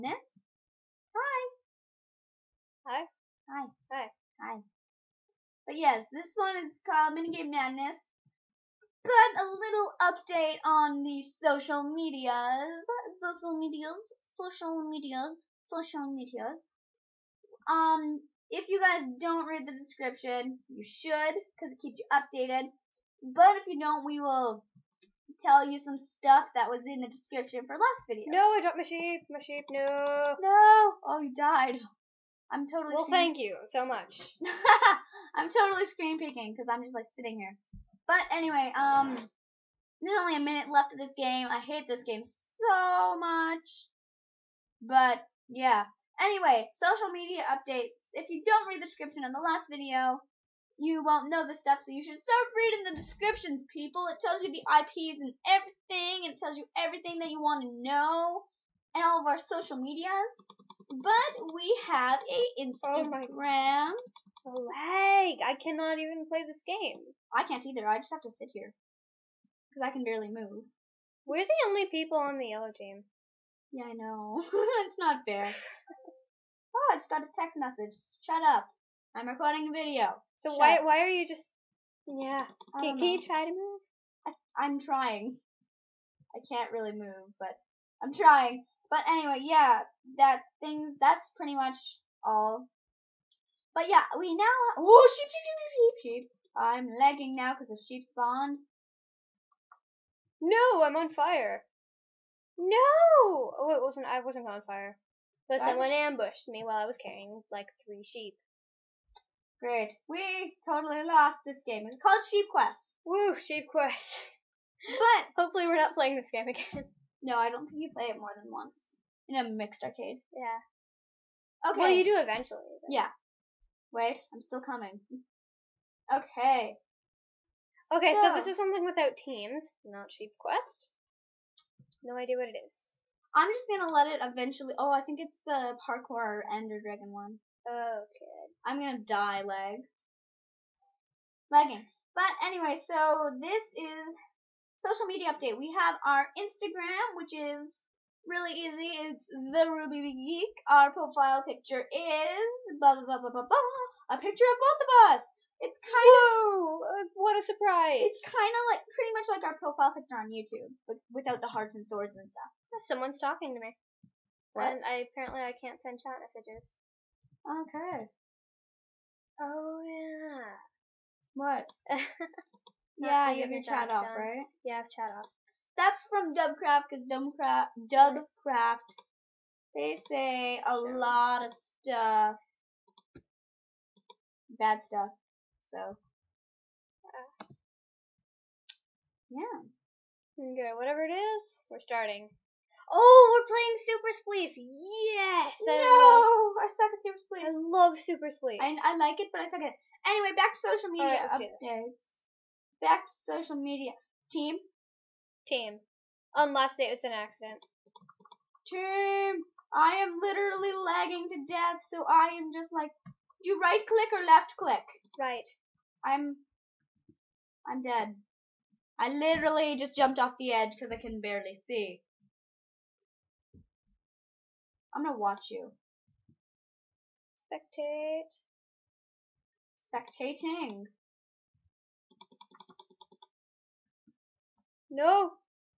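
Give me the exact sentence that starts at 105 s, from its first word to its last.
But someone ambushed me while I was carrying, like, three sheep.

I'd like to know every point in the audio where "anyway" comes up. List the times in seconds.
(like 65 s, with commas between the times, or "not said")
38 s, 46 s, 89 s, 142 s, 200 s.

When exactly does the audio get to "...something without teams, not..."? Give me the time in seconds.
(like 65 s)
128 s.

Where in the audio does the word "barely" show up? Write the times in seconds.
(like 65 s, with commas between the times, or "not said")
70 s, 221 s.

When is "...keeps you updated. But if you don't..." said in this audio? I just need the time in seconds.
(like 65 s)
21 s.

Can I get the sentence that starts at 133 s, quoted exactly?
I'm just gonna let it eventually.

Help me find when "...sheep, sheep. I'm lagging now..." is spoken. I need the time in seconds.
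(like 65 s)
95 s.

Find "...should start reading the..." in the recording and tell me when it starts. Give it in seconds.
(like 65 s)
52 s.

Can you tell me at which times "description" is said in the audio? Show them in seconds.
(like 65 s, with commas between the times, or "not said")
19 s, 27 s, 48 s, 52 s.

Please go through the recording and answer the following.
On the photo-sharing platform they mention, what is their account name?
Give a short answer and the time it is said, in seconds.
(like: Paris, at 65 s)
The Rubie Geek, at 149 s.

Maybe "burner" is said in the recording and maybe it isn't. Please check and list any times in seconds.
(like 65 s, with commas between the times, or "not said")
not said.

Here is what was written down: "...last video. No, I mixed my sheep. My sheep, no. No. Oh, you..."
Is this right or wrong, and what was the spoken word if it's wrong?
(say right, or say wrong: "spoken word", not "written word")
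wrong: "dropped", not "mixed".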